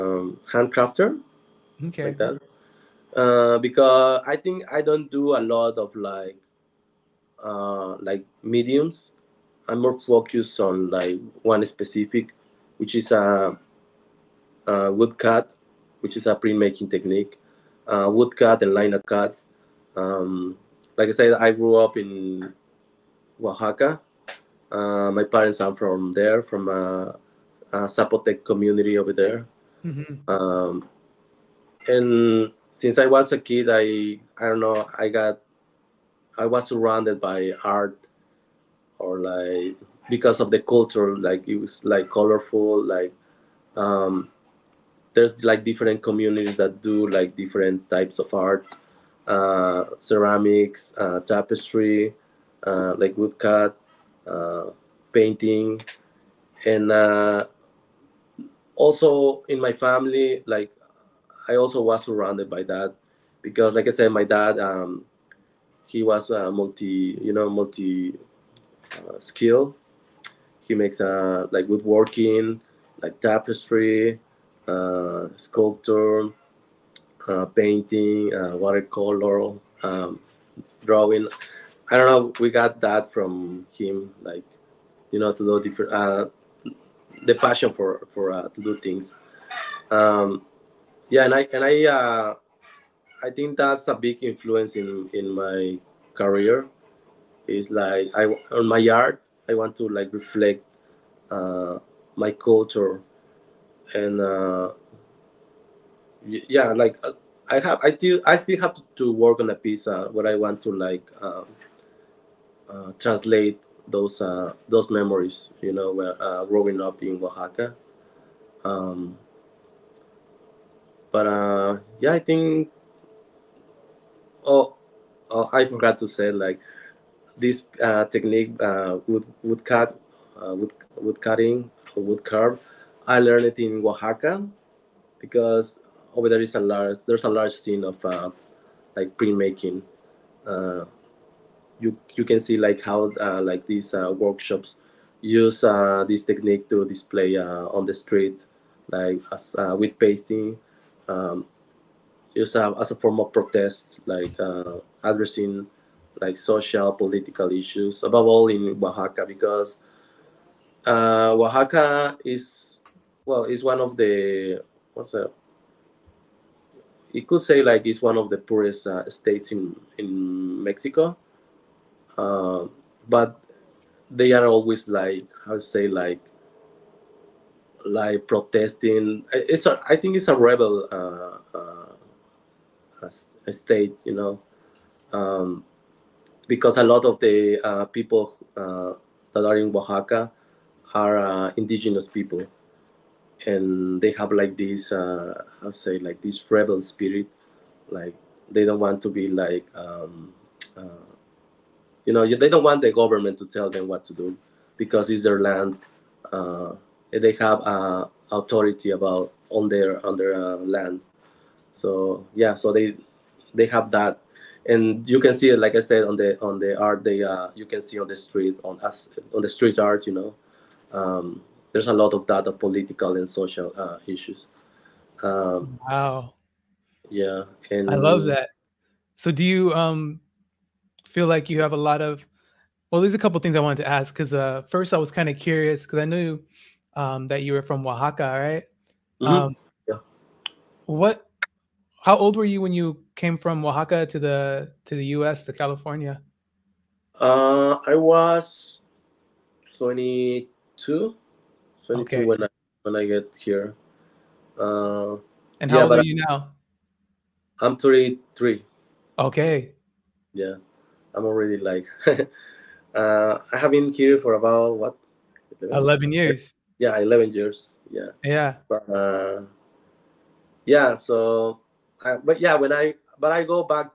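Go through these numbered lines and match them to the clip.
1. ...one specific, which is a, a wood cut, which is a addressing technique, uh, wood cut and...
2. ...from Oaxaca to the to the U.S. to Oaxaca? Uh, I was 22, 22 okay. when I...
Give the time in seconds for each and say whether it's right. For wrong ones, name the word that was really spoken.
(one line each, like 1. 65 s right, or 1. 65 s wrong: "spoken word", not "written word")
1. 11 s wrong: "printmaking", not "addressing"
2. 243 s wrong: "California", not "Oaxaca".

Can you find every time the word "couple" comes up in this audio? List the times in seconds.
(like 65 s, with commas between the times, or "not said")
233 s.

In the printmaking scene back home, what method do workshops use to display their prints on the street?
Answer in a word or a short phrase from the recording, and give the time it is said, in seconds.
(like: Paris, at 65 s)
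Pasting, at 149 s.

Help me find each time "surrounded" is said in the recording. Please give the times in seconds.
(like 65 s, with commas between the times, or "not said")
36 s, 62 s.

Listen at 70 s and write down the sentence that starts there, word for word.
He makes uh, like woodworking, like tapestry, uh, sculpture, uh, painting, uh, watercolor, um, drawing.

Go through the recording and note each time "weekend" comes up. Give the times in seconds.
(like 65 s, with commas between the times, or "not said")
not said.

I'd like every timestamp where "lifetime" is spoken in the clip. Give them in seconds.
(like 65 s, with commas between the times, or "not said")
not said.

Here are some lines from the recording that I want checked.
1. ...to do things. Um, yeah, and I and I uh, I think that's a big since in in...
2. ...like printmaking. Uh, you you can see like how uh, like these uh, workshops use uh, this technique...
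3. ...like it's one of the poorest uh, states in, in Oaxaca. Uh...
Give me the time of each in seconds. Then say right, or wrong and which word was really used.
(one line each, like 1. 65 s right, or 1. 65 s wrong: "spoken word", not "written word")
1. 88 s wrong: "influence", not "since"
2. 138 s right
3. 167 s wrong: "Mexico", not "Oaxaca".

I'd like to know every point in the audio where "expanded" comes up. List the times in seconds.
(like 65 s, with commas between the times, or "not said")
not said.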